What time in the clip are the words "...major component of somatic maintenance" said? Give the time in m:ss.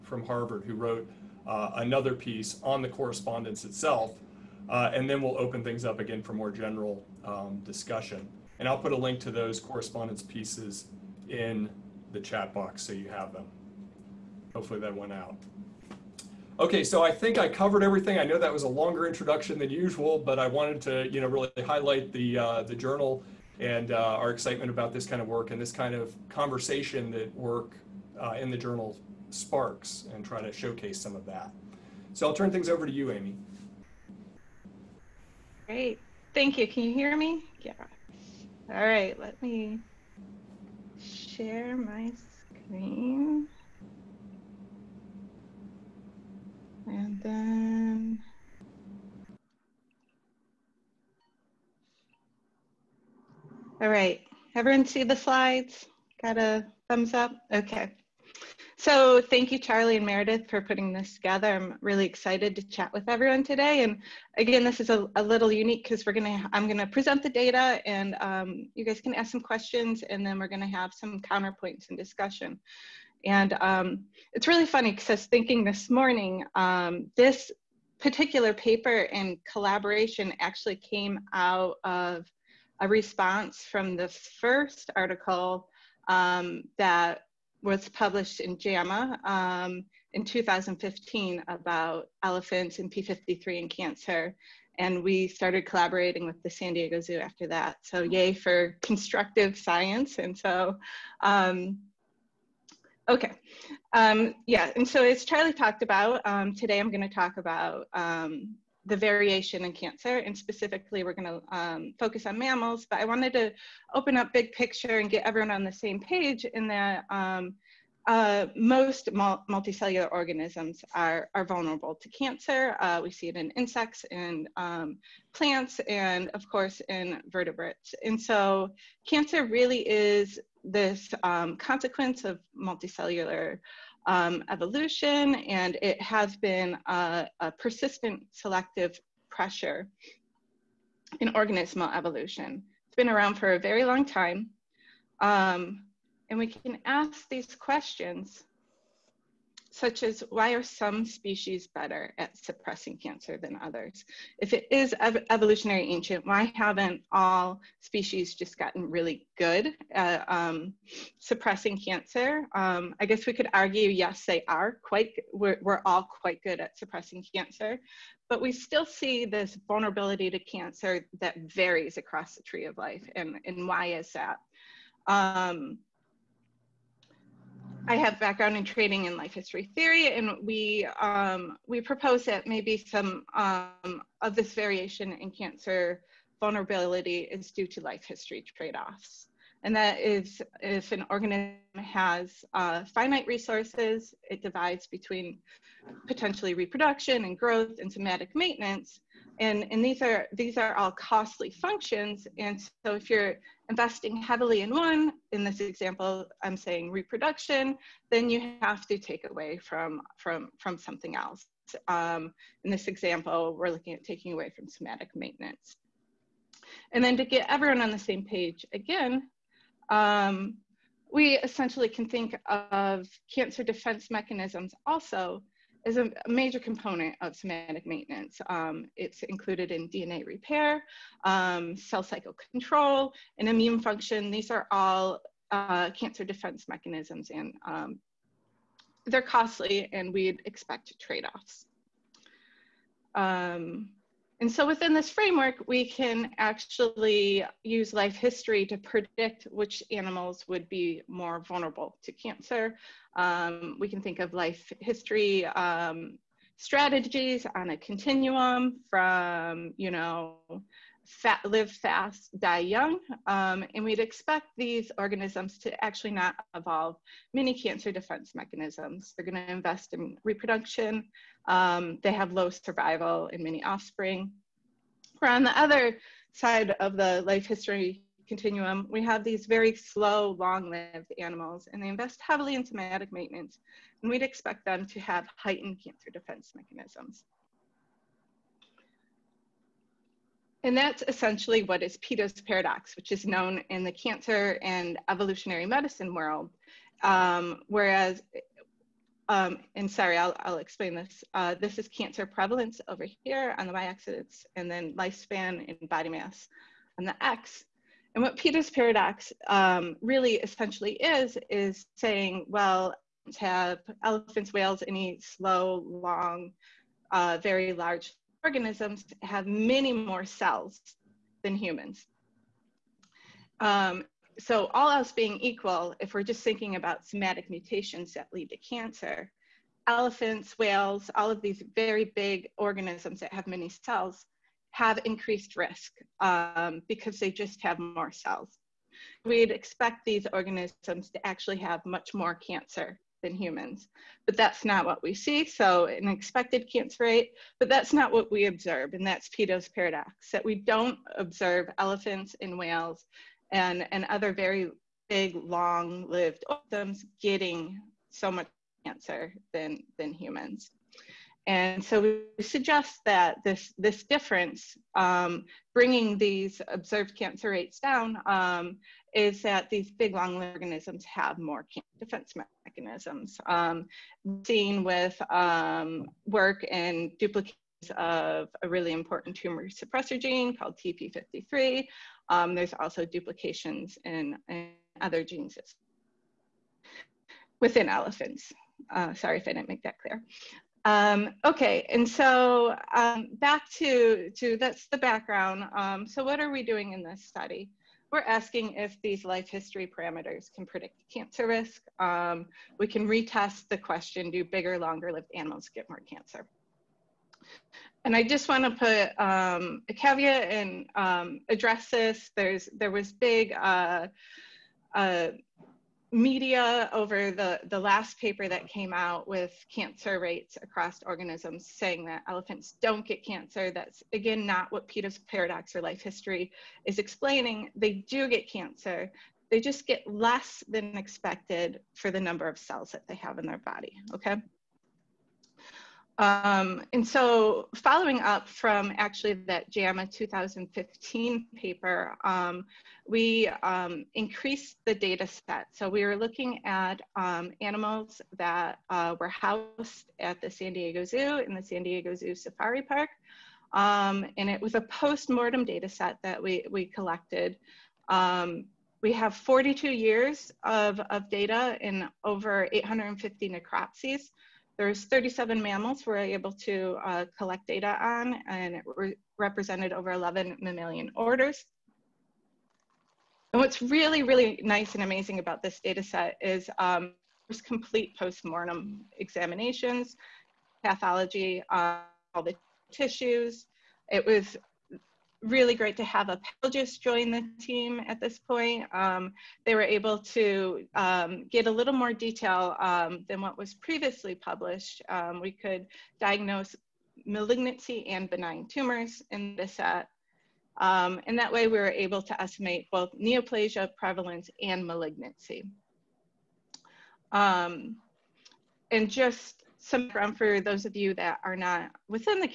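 3:46.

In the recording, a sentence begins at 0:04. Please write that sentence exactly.
Uh, and then we'll open things up again for more general um, discussion.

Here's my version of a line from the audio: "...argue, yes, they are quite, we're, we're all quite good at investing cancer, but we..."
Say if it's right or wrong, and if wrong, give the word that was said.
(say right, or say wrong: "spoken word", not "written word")
wrong: "suppressing", not "investing".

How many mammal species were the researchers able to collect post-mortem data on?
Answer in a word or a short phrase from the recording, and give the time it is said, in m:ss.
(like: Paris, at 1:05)
37, at 7:45.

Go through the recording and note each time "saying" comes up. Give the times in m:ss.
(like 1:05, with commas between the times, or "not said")
3:26, 5:11, 7:01.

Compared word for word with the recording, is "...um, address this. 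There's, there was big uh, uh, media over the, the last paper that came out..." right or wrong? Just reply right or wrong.
right.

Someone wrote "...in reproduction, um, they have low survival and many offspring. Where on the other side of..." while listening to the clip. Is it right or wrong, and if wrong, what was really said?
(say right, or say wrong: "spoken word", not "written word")
right.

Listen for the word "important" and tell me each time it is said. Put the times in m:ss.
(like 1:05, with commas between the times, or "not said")
6:18.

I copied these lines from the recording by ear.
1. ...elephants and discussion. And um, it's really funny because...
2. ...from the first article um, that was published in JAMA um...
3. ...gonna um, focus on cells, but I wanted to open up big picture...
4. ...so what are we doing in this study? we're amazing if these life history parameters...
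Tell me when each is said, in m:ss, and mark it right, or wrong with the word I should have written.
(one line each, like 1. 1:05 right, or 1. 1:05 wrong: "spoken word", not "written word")
1. 1:11 wrong: "counterpoints", not "elephants"
2. 1:23 right
3. 1:51 wrong: "mammals", not "cells"
4. 6:36 wrong: "asking", not "amazing".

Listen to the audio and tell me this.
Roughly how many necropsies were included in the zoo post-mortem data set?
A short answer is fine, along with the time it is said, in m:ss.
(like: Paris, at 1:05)
over 850, at 7:42.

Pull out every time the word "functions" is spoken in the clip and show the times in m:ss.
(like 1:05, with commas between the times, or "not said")
3:21, 3:53.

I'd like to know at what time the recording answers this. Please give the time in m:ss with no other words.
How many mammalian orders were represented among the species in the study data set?
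7:49.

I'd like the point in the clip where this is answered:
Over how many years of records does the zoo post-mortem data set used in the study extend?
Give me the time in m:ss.
7:39.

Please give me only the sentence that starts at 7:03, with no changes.
That's again not what Peto's paradox or life history is explaining.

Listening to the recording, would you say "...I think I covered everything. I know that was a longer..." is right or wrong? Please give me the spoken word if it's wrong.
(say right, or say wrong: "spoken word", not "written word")
right.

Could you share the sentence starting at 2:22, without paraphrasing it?
It's been around for a very long time.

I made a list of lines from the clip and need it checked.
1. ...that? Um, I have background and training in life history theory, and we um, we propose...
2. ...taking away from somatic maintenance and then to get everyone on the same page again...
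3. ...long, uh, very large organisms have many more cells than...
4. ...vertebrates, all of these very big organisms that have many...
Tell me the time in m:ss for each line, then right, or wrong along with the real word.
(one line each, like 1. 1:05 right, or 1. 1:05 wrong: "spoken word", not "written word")
1. 2:54 right
2. 3:34 right
3. 5:15 right
4. 5:30 wrong: "whales", not "vertebrates".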